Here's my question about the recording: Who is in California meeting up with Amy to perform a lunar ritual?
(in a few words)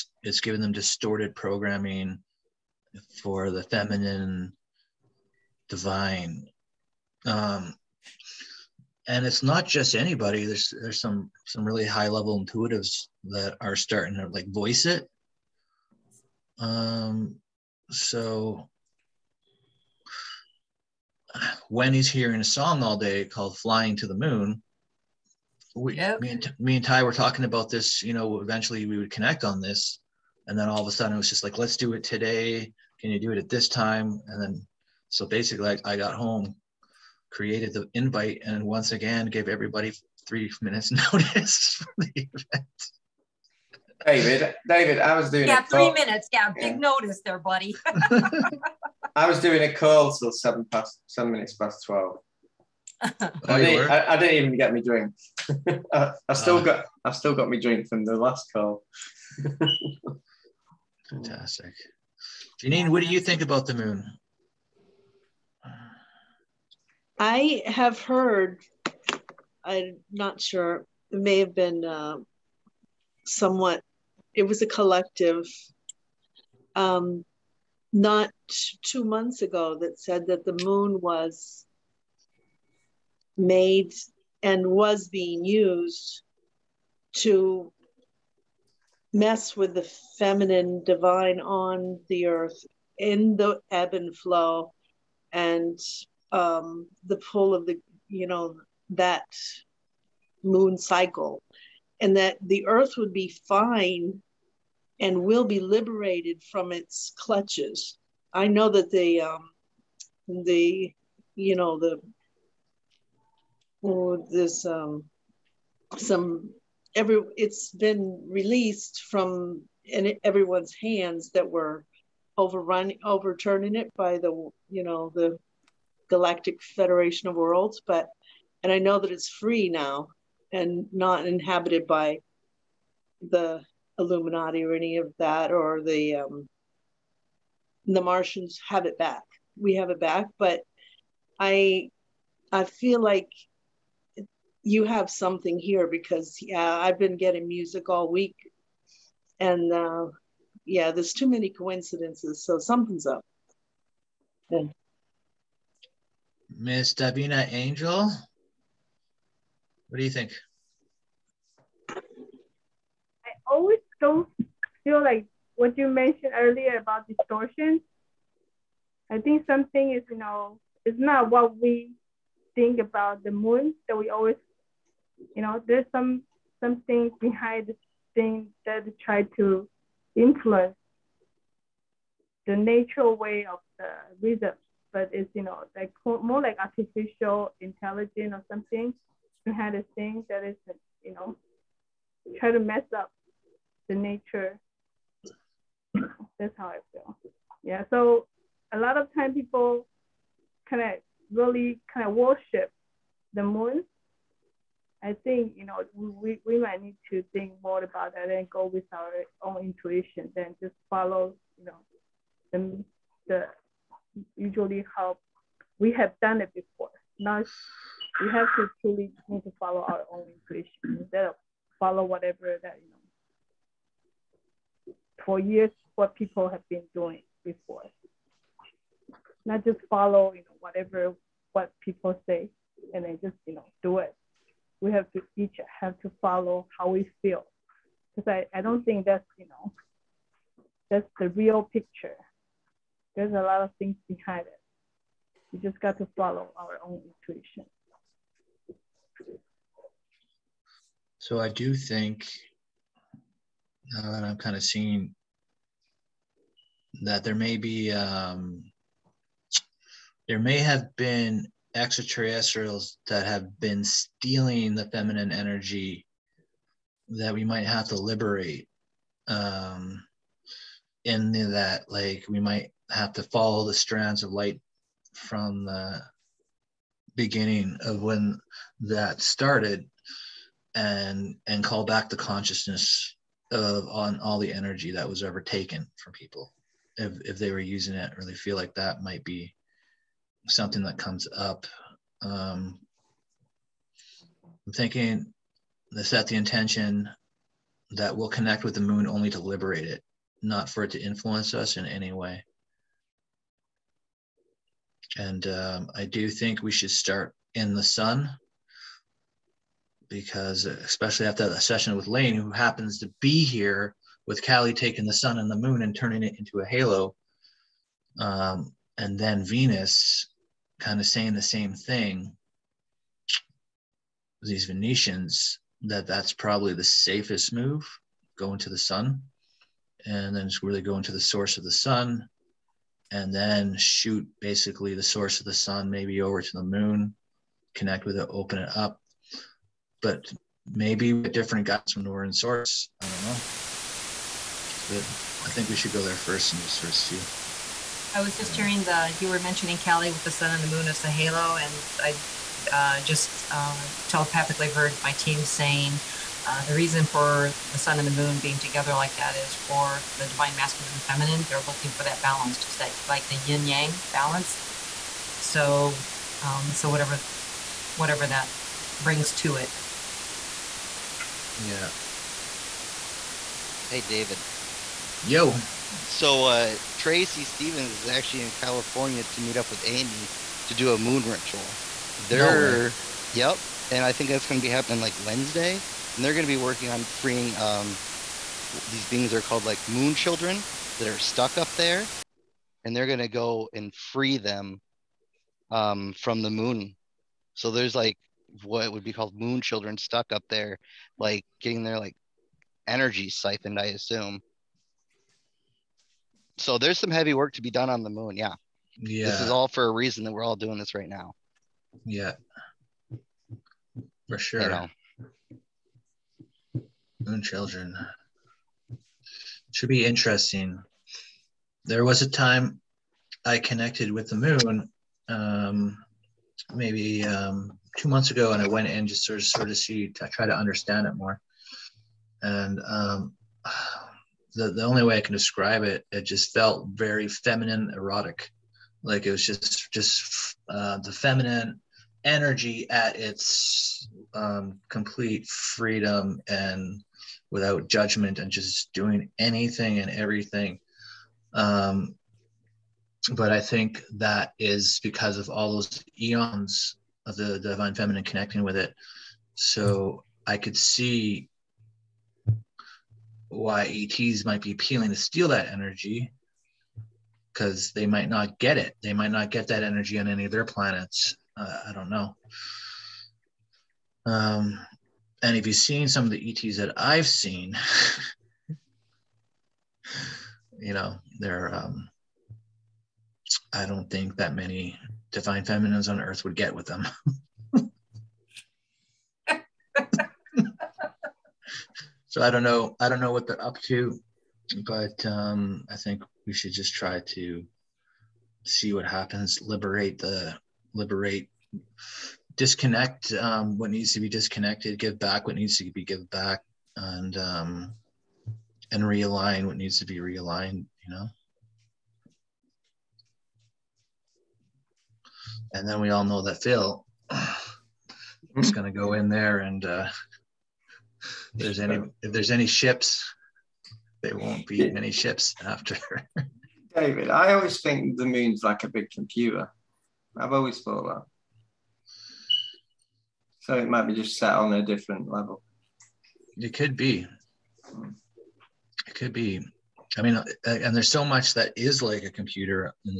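Tracy Stevens.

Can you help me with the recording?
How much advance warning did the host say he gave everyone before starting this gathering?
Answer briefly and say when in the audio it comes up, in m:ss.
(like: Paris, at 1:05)
3 minutes, at 0:40.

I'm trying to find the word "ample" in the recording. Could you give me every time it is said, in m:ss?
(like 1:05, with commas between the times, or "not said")
not said.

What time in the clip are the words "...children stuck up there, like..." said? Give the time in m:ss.
6:39.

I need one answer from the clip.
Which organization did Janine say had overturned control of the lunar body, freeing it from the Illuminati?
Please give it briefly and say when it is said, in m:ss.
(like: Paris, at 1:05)
galactic federation of worlds, at 2:06.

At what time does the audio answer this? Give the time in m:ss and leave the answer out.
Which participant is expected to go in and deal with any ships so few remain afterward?
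8:36.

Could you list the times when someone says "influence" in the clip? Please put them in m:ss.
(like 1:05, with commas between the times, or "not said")
3:00, 5:01.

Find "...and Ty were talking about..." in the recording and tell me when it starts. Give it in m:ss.
0:26.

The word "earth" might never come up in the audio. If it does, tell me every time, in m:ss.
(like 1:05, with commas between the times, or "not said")
1:32, 1:42, 8:06.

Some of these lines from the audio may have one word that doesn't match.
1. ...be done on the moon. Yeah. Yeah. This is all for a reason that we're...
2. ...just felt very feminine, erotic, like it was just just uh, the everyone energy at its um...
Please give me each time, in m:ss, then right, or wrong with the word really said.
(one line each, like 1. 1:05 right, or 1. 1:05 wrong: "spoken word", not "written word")
1. 6:47 right
2. 7:16 wrong: "feminine", not "everyone".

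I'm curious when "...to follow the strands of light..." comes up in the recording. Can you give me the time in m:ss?
4:33.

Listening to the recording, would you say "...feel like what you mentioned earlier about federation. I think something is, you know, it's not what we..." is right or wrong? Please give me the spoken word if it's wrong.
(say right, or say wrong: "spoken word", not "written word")
wrong: "distortion", not "federation".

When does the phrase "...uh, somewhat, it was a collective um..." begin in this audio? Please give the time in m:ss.
1:11.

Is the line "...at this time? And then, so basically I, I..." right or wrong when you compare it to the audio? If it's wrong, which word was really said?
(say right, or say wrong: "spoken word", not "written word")
right.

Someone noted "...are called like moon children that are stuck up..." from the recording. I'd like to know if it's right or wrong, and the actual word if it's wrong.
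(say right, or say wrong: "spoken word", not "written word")
right.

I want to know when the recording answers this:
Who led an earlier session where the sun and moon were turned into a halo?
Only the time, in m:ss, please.
5:12.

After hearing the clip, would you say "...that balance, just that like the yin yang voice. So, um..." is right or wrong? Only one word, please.
wrong.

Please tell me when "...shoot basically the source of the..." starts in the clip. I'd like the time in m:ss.
5:33.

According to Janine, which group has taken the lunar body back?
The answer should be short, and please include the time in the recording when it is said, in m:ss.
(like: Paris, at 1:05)
the Martians, at 2:17.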